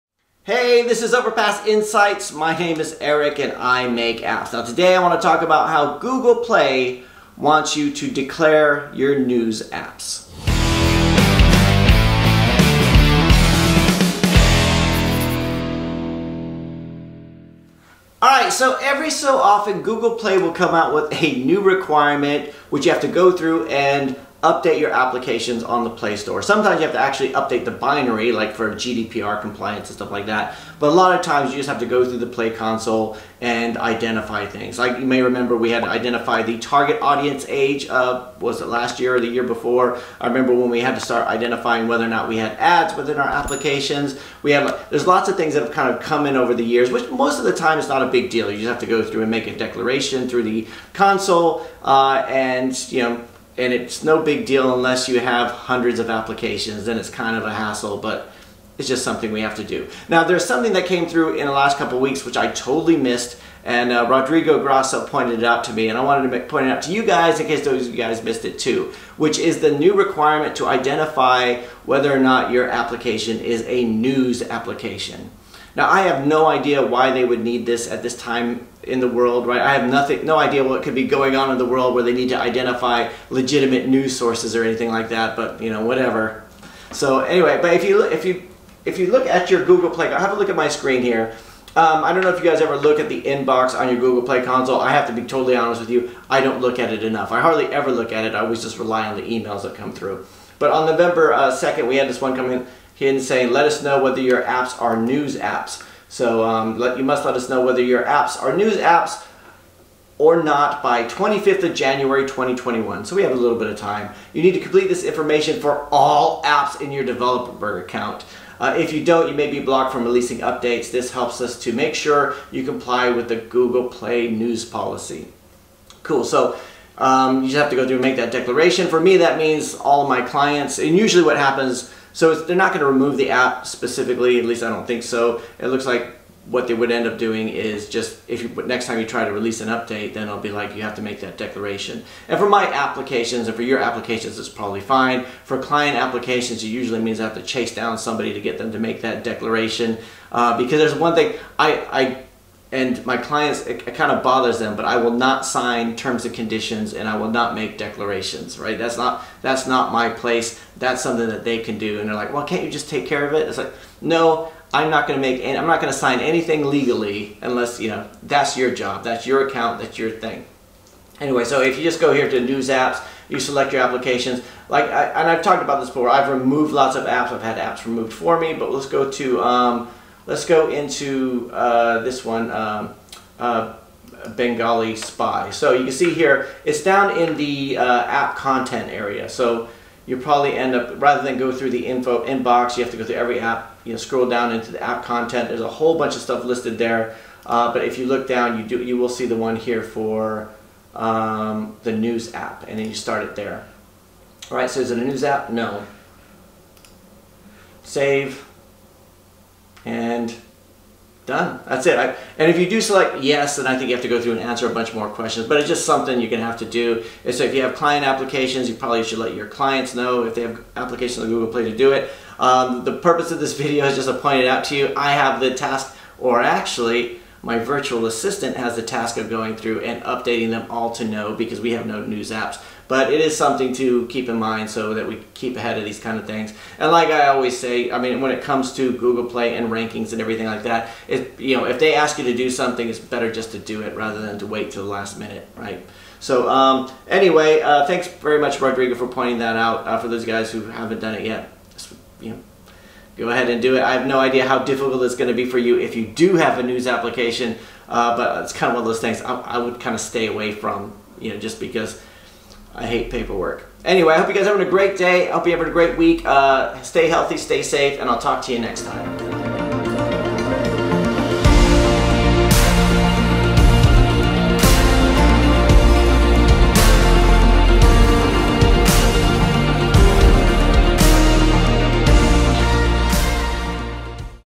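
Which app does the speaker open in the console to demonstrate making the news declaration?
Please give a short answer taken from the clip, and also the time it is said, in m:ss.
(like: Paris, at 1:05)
Bengali Spy, at 3:04.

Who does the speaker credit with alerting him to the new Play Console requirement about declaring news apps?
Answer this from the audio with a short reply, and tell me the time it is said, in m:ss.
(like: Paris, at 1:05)
Rodrigo Grasso, at 1:04.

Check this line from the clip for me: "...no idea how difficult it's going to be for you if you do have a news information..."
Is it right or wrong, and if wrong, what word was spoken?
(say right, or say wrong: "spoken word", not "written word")
wrong: "application", not "information".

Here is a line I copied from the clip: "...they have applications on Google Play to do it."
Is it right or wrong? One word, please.
right.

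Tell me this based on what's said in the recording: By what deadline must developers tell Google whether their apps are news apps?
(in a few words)
25 January 2021.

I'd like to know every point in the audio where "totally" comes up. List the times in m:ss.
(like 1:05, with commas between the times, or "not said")
1:02, 1:35.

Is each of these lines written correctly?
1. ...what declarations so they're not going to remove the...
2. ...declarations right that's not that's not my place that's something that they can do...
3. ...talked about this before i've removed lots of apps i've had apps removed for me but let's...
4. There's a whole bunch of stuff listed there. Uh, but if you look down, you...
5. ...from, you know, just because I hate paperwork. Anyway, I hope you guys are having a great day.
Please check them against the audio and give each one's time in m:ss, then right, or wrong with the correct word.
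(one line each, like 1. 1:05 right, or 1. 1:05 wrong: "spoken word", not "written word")
1. 2:11 wrong: "happens", not "declarations"
2. 2:37 right
3. 2:55 right
4. 3:15 right
5. 4:20 right.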